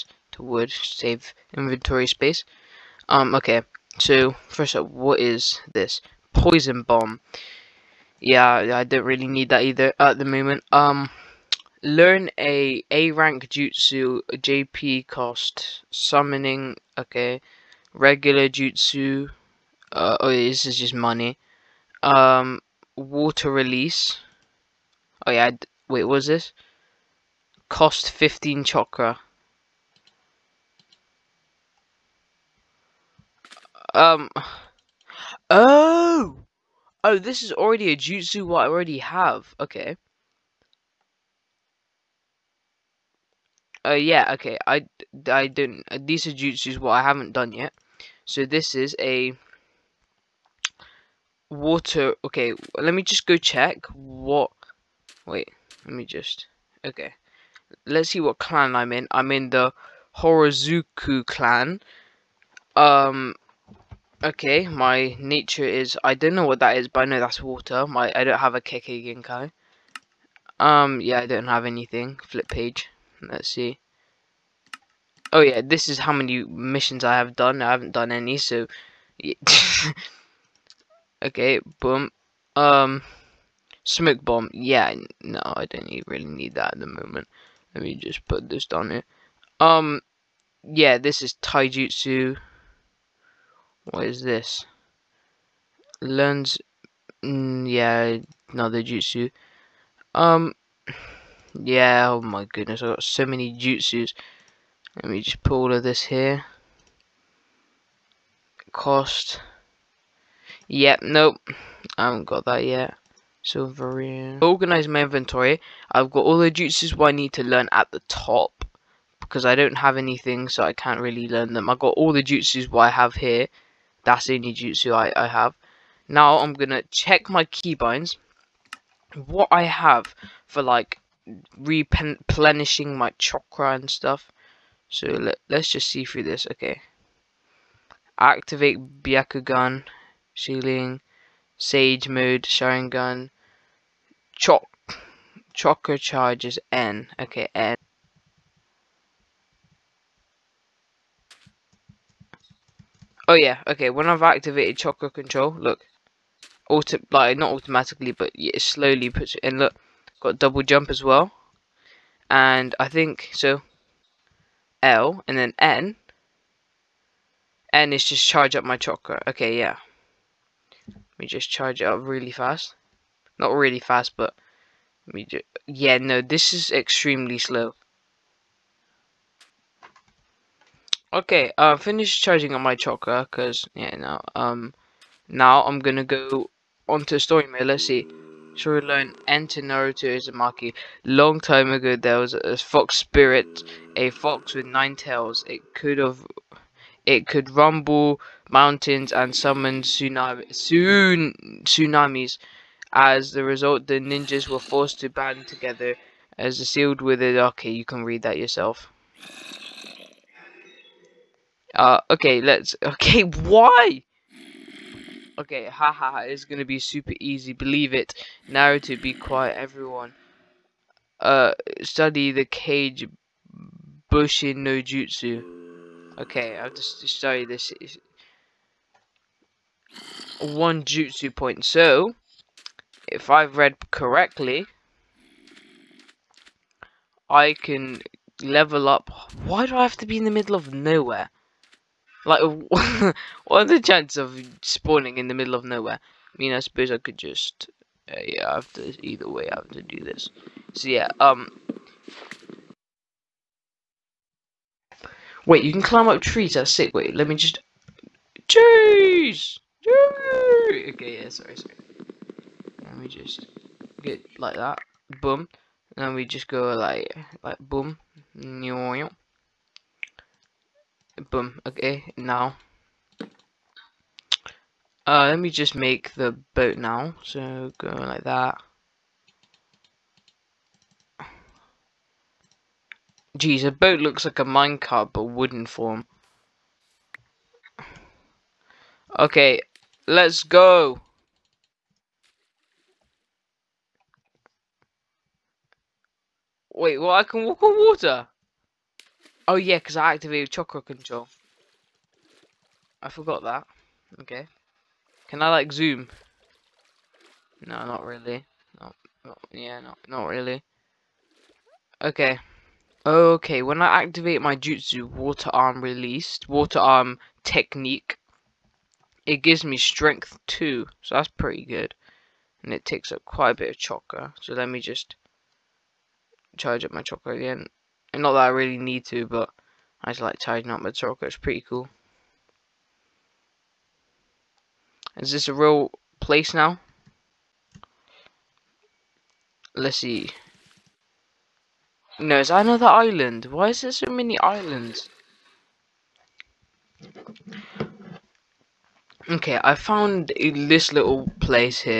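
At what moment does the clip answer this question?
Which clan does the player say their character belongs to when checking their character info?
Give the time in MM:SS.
01:00.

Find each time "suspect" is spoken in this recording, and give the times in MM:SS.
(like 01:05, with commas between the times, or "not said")
not said.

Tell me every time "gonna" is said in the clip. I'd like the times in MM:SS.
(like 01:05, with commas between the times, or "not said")
02:06, 03:05, 03:36.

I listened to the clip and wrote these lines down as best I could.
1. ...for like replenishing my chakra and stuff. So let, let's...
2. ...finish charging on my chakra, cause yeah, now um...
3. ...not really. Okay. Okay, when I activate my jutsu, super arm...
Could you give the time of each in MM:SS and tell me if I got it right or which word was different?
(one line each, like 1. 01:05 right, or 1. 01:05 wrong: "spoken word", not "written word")
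1. 02:10 right
2. 03:01 right
3. 05:10 wrong: "water", not "super".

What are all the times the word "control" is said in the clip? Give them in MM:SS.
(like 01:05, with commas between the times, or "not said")
02:35, 05:00.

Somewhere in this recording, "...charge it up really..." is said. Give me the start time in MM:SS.
02:51.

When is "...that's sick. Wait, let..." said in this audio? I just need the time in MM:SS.
04:16.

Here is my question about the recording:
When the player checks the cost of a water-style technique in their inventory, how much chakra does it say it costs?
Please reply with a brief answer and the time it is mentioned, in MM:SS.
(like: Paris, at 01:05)
15, at 00:27.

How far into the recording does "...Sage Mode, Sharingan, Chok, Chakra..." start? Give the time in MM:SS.
02:21.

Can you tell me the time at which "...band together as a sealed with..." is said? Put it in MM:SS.
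03:25.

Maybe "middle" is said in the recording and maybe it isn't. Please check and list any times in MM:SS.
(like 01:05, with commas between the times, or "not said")
04:00, 04:05.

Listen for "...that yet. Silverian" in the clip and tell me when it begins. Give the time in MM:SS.
01:52.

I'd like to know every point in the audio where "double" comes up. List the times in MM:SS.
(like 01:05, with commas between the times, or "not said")
02:40.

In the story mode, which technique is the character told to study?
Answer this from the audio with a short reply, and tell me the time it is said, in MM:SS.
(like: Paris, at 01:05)
Kage Bushin no Jutsu, at 03:42.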